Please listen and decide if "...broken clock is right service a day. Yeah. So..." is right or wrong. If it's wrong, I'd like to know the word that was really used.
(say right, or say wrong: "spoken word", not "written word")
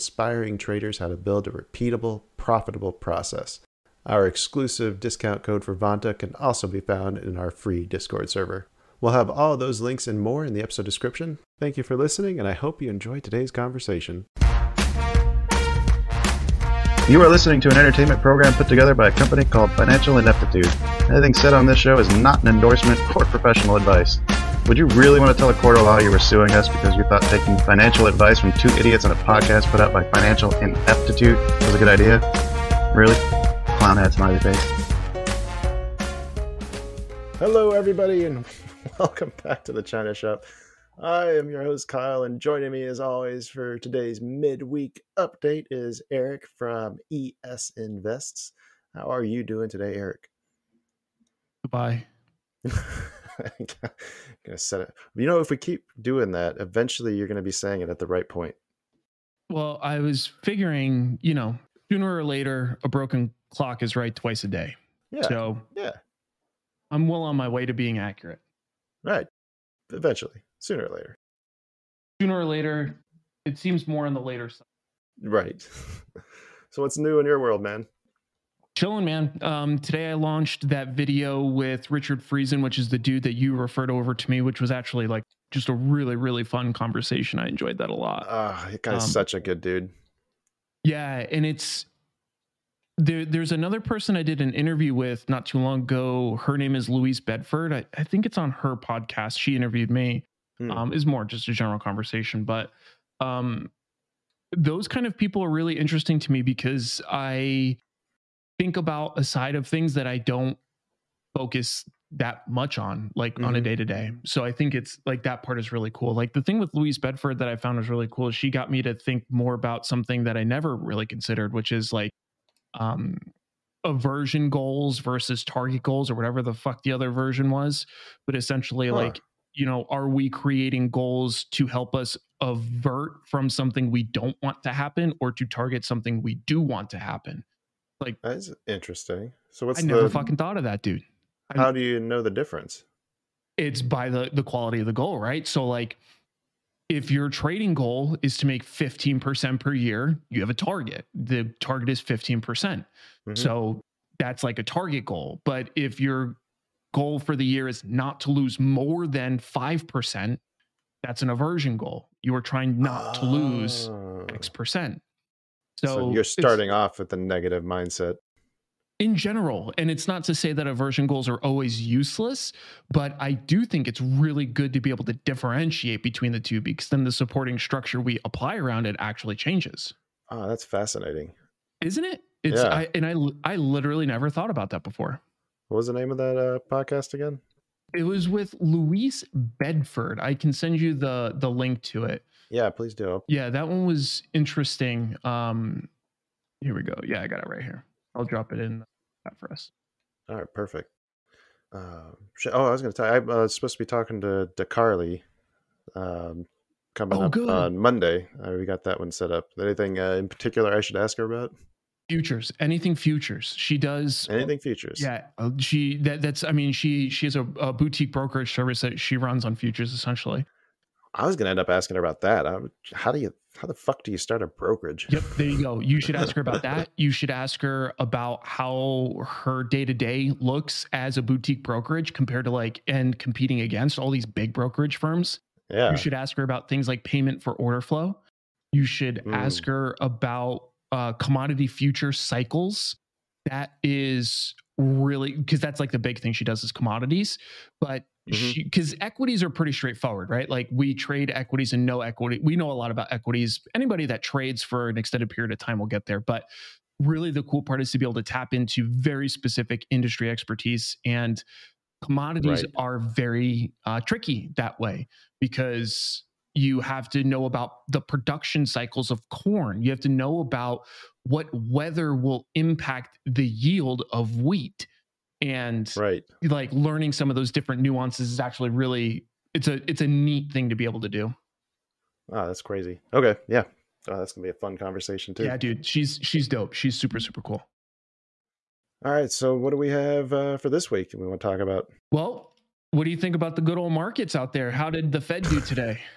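wrong: "twice", not "service".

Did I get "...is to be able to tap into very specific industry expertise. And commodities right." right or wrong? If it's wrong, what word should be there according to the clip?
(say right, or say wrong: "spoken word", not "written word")
right.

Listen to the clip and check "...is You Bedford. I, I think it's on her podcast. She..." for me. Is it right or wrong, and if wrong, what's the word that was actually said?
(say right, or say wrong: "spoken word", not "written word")
wrong: "Louise", not "You".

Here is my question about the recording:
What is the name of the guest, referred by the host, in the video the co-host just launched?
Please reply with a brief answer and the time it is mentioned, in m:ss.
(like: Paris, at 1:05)
Richard Friesen, at 1:21.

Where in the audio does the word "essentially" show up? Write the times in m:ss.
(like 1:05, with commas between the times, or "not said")
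2:08, 3:39.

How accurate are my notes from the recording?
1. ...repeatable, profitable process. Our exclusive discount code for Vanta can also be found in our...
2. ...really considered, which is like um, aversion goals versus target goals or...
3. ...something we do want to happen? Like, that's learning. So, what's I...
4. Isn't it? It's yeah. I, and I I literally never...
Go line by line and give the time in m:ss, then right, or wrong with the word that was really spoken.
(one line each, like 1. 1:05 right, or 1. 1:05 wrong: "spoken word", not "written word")
1. 0:01 right
2. 2:00 right
3. 2:15 wrong: "interesting", not "learning"
4. 3:01 right.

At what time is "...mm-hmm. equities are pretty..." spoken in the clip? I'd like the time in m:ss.
4:08.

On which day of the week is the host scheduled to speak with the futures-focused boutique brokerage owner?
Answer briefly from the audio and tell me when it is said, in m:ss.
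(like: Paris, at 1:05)
Monday, at 3:27.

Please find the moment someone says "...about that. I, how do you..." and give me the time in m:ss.
3:42.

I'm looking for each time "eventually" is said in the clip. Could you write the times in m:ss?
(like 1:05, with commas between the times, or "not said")
0:56, 1:09.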